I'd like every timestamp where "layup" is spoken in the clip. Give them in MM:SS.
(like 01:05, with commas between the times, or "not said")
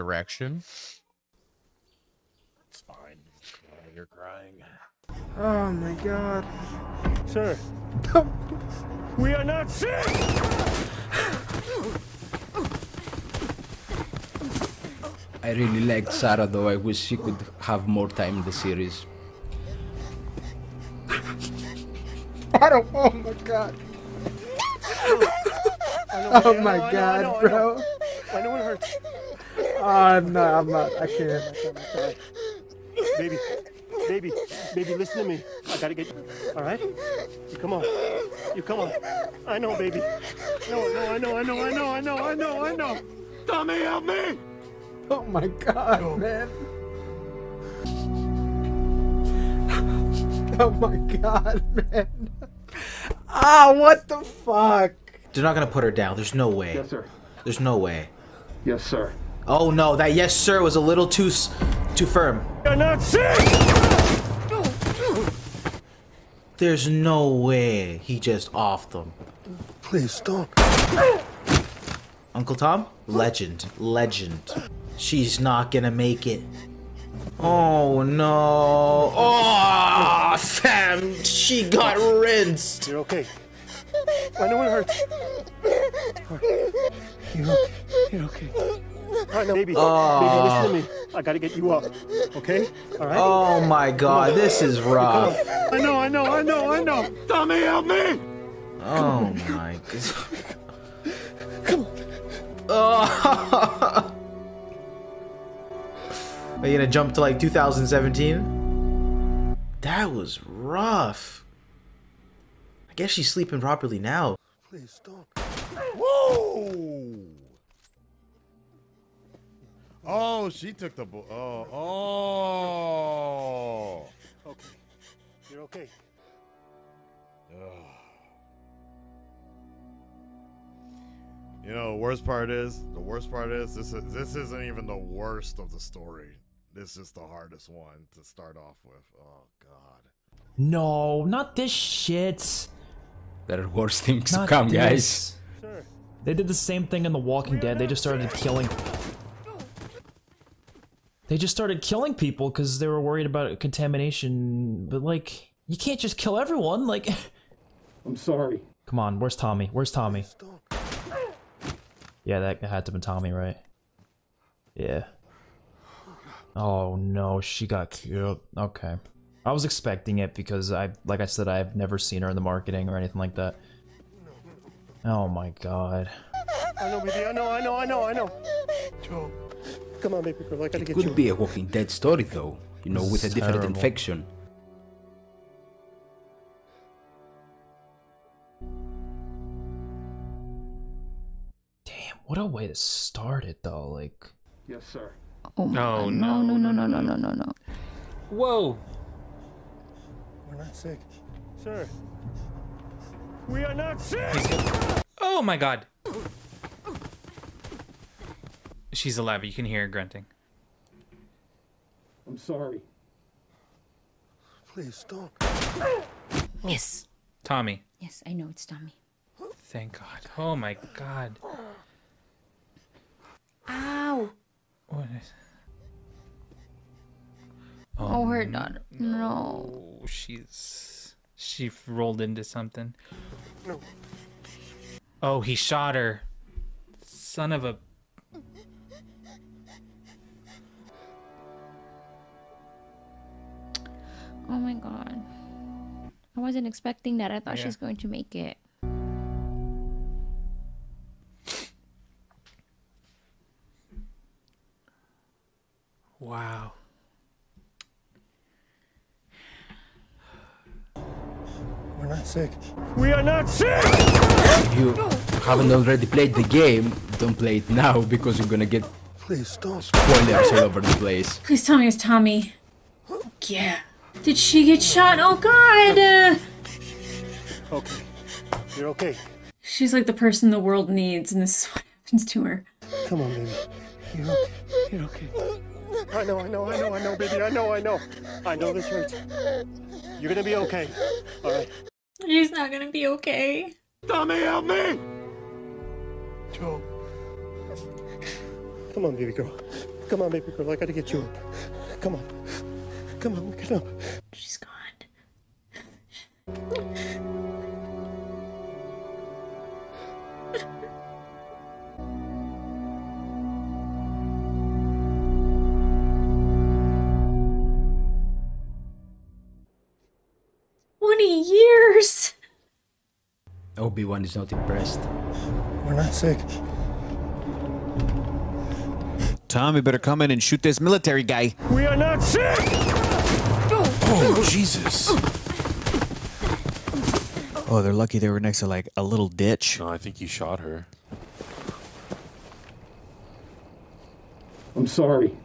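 not said.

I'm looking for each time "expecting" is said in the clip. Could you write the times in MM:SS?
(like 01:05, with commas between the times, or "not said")
02:49, 04:06.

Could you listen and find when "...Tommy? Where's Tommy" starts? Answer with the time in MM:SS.
02:39.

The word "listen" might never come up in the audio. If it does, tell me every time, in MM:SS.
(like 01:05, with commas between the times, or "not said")
00:34, 01:29.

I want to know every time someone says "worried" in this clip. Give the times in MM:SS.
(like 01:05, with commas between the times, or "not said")
02:33.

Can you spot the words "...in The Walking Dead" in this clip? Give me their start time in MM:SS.
02:27.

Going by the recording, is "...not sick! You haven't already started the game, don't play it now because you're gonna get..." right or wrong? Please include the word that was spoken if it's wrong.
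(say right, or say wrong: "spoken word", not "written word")
wrong: "played", not "started".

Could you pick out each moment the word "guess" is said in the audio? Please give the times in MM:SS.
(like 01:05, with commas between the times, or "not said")
01:52.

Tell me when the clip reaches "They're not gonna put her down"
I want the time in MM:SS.
00:55.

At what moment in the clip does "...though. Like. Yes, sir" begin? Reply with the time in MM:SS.
03:13.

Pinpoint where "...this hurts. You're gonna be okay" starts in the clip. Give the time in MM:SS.
04:48.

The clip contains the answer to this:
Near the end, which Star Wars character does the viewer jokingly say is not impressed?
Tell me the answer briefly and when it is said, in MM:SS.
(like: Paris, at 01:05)
Obi-Wan, at 05:23.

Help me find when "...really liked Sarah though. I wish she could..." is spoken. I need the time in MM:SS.
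00:15.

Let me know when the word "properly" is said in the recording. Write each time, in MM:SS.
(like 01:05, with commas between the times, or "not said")
01:53.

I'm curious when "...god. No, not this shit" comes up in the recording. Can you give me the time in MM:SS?
02:19.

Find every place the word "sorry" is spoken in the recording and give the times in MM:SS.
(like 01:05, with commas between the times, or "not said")
02:38, 03:32, 05:44.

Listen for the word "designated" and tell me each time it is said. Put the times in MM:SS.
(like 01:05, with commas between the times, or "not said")
not said.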